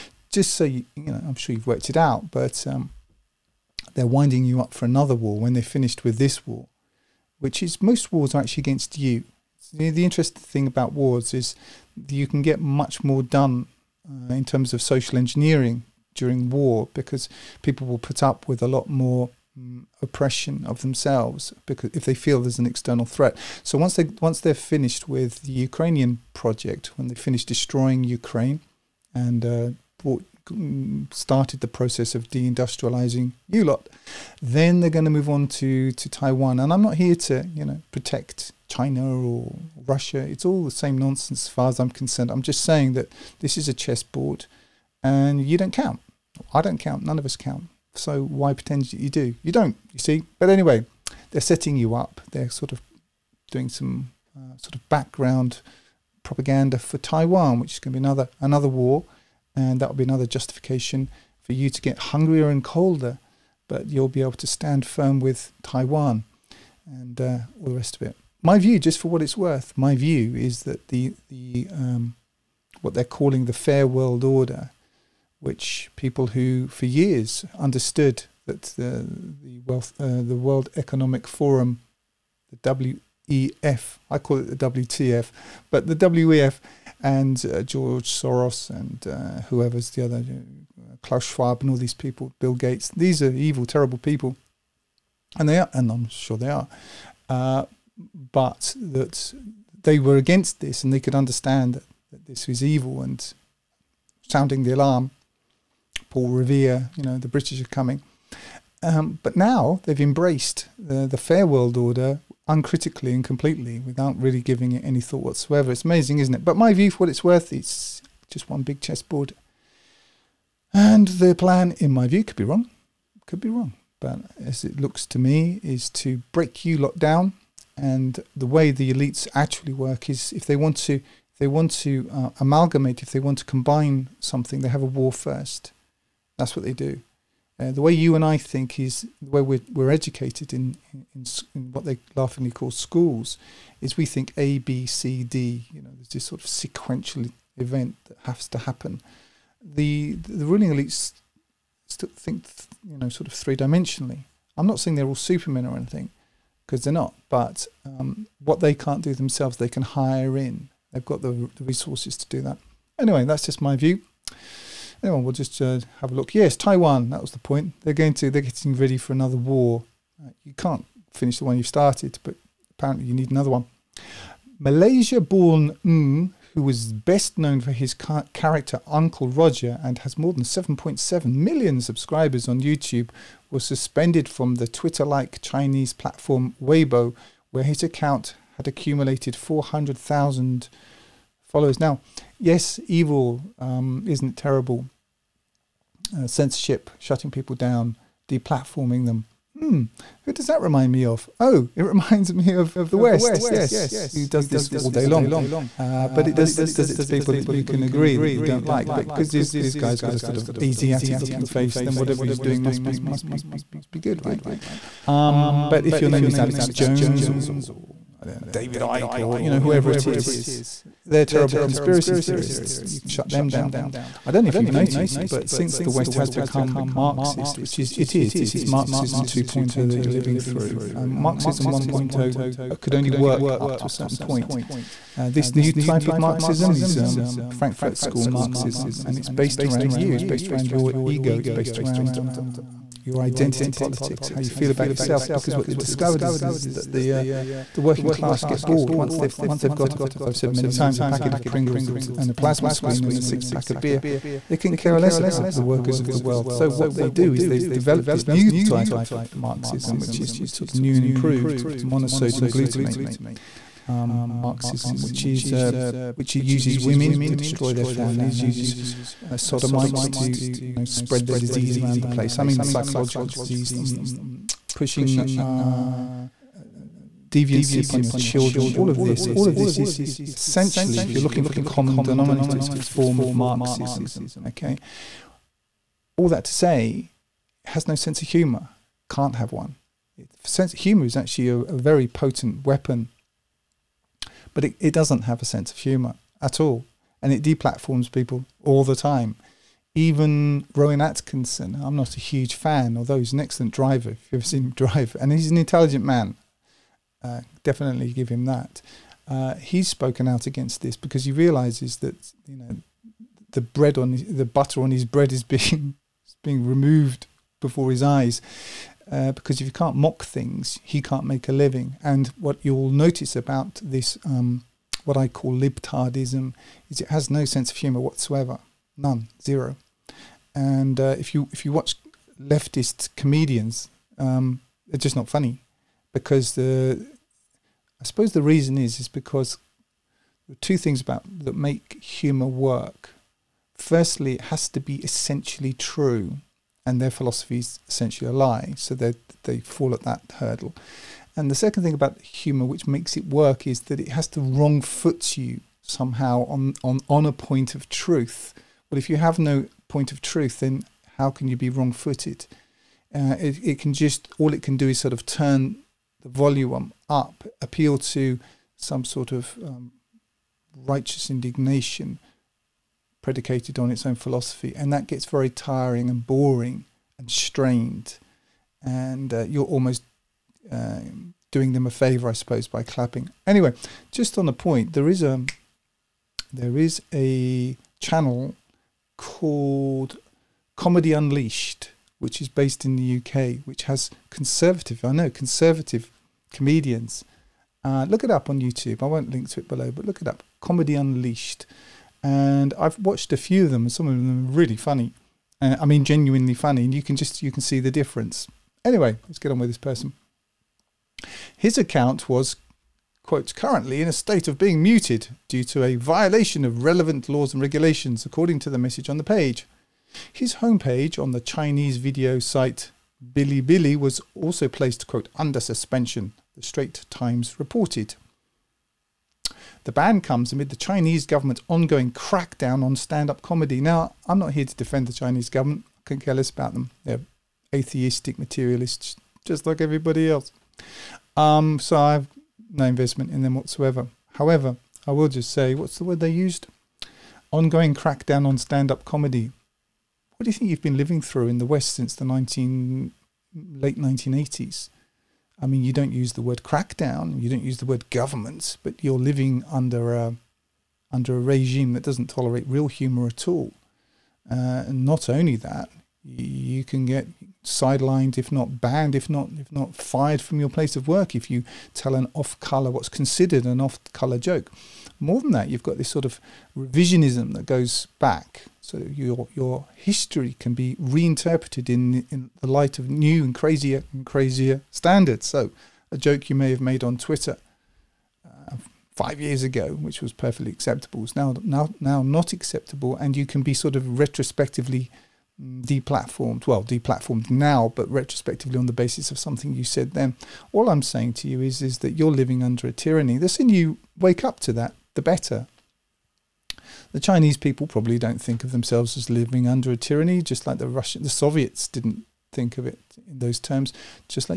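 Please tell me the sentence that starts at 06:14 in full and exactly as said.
And that gets very tiring and boring and strained.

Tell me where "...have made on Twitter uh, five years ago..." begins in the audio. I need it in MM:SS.
08:06.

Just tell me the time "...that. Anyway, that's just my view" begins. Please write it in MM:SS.
02:42.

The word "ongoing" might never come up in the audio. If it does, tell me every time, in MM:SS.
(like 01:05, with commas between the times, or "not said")
07:11, 07:27.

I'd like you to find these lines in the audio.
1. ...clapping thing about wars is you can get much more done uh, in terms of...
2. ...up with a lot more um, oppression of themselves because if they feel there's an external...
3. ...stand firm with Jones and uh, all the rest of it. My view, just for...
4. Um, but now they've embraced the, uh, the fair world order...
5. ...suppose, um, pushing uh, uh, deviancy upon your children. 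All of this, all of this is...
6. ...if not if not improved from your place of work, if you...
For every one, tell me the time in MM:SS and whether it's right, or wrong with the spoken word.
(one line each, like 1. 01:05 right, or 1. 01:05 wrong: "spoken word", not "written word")
1. 00:10 wrong: "interesting", not "clapping"
2. 00:18 right
3. 01:04 wrong: "Taiwan", not "Jones"
4. 01:48 right
5. 04:33 wrong: "disease", not "suppose"
6. 07:49 wrong: "fired", not "improved".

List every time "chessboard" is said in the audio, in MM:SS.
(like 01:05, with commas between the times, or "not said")
00:43, 01:58.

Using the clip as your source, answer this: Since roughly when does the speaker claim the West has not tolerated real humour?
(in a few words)
Late 1980s.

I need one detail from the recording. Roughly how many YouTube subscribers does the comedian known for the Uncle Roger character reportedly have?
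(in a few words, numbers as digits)
7.7 million.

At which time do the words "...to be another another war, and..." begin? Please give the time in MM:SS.
00:57.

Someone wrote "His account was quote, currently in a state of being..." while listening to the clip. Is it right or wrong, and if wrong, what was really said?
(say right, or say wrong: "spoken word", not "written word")
right.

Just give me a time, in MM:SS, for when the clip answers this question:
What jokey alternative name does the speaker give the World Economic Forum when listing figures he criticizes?
01:24.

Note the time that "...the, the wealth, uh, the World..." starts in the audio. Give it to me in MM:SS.
01:18.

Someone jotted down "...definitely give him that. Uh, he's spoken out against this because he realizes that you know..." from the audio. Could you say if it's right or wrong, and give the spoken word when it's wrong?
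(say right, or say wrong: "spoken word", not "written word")
right.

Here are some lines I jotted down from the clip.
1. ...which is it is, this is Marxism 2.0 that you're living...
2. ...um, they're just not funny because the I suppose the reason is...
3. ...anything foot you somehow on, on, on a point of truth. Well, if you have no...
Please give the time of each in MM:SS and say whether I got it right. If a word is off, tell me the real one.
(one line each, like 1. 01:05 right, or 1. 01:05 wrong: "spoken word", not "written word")
1. 03:47 right
2. 05:34 right
3. 05:54 wrong: "wrong", not "anything".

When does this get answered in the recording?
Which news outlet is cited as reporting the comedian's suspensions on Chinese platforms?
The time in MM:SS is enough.
07:06.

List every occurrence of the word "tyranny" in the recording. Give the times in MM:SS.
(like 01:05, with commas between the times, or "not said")
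08:22, 08:29.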